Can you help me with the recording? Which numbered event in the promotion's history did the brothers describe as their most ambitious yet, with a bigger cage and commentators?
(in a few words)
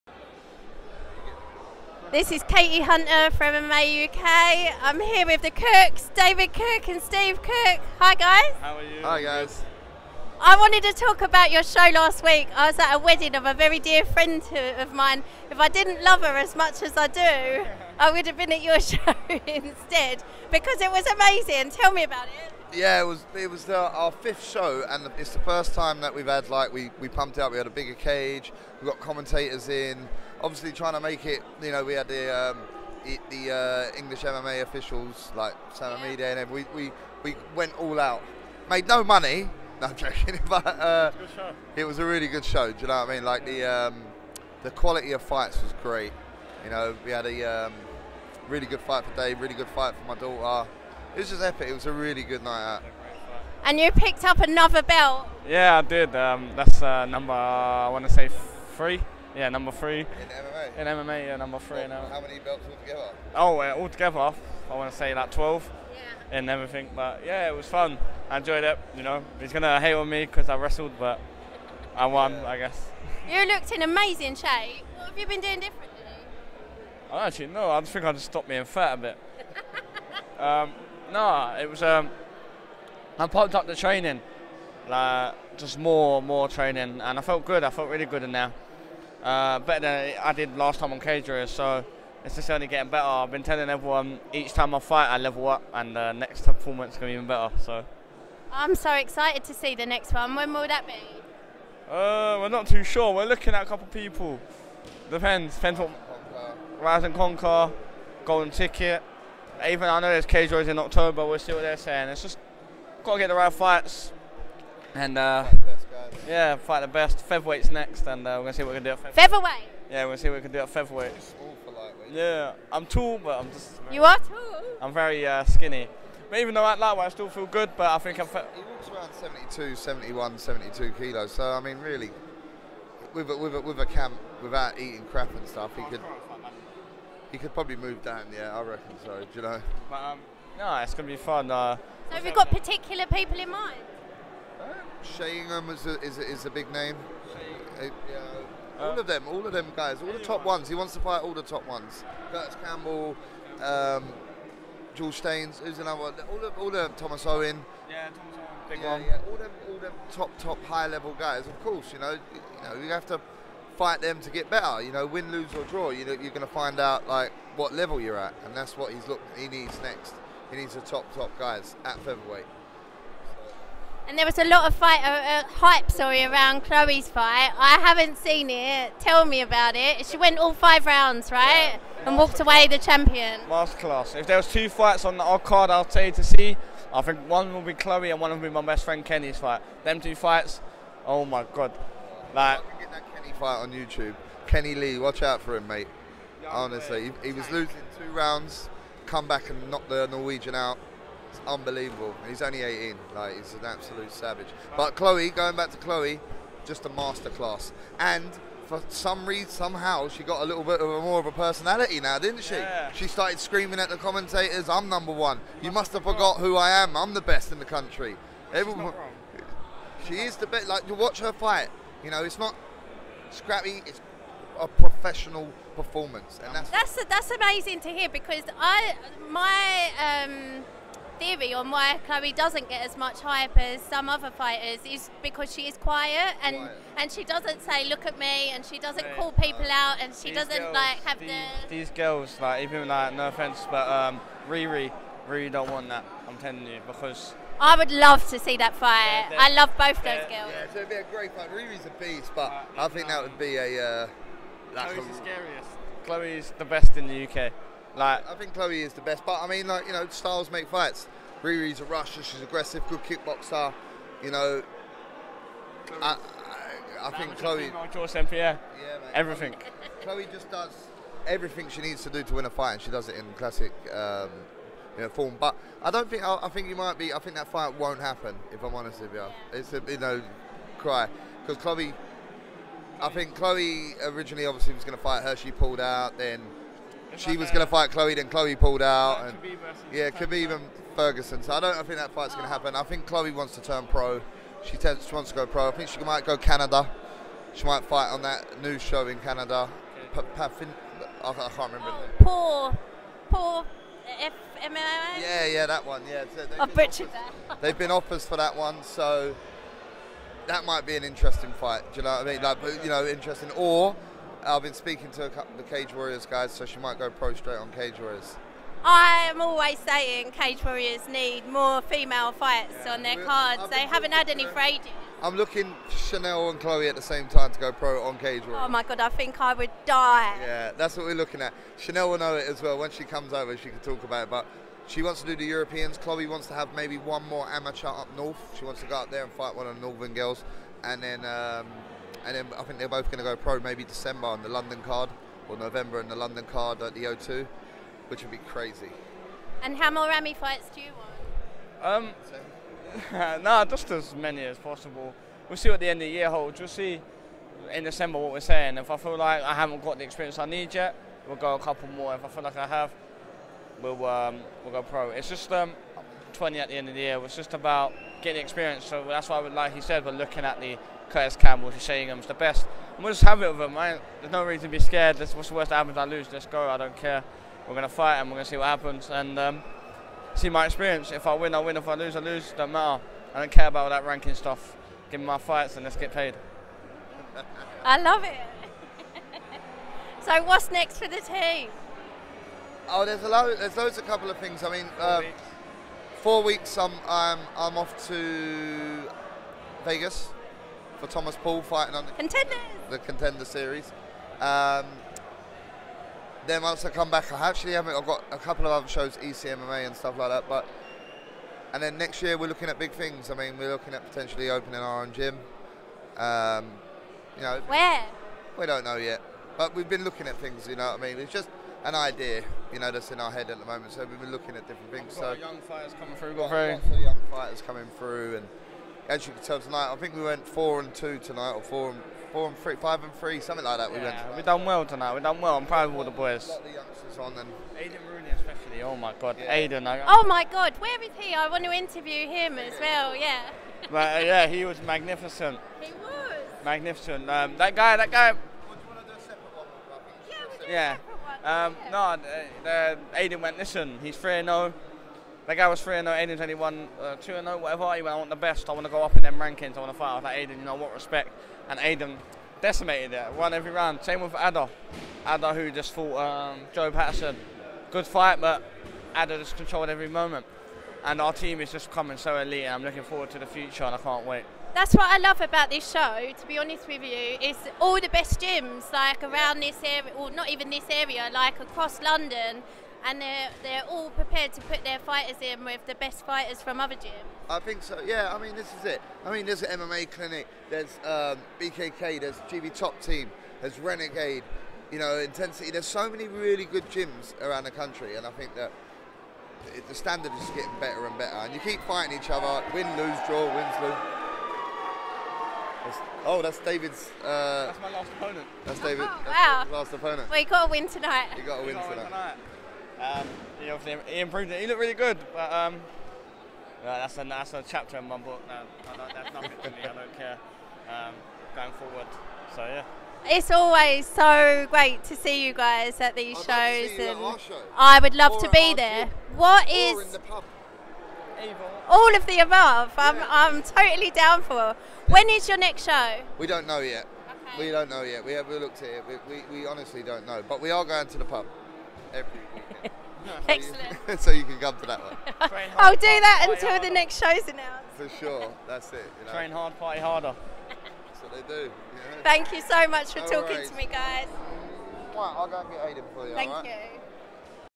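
fifth.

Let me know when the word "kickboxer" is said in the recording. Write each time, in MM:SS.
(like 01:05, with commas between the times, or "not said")
04:23.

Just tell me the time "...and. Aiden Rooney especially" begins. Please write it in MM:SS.
07:17.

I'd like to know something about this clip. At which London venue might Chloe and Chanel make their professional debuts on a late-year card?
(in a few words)
the O2.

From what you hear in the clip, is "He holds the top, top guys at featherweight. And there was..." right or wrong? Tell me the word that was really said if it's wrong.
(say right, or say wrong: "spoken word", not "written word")
wrong: "needs", not "holds".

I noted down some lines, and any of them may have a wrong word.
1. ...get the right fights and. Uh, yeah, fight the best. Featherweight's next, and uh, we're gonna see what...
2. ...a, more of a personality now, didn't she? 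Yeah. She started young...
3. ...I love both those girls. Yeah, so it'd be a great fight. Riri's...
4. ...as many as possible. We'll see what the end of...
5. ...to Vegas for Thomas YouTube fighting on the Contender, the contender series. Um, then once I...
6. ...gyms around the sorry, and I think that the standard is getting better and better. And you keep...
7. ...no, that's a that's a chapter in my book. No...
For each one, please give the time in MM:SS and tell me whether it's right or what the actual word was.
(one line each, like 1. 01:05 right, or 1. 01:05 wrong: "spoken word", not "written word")
1. 01:53 right
2. 03:30 wrong: "screaming", not "young"
3. 04:09 right
4. 05:53 right
5. 06:38 wrong: "Paul", not "YouTube"
6. 08:16 wrong: "country", not "sorry"
7. 08:35 right.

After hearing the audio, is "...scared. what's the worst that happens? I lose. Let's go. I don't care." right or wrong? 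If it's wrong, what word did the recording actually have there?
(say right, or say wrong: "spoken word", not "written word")
right.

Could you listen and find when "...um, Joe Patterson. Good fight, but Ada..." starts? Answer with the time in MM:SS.
07:46.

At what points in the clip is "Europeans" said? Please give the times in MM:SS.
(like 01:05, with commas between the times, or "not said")
05:35.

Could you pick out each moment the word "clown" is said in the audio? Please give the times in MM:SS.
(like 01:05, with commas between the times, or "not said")
not said.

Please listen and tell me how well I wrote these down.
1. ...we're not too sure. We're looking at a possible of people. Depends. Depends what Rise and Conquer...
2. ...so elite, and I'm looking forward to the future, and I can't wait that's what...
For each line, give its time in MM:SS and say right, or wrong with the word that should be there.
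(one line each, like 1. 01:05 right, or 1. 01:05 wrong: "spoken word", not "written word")
1. 01:42 wrong: "couple", not "possible"
2. 07:52 right.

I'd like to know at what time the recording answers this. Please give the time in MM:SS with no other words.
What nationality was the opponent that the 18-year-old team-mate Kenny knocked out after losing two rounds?
03:20.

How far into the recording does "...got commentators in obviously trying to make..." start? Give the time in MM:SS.
00:28.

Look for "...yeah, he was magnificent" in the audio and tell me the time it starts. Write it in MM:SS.
07:24.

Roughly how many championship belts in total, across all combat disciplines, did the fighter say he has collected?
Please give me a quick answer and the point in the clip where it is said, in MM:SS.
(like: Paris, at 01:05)
12, at 01:05.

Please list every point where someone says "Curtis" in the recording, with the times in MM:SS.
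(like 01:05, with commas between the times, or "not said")
02:32, 06:11.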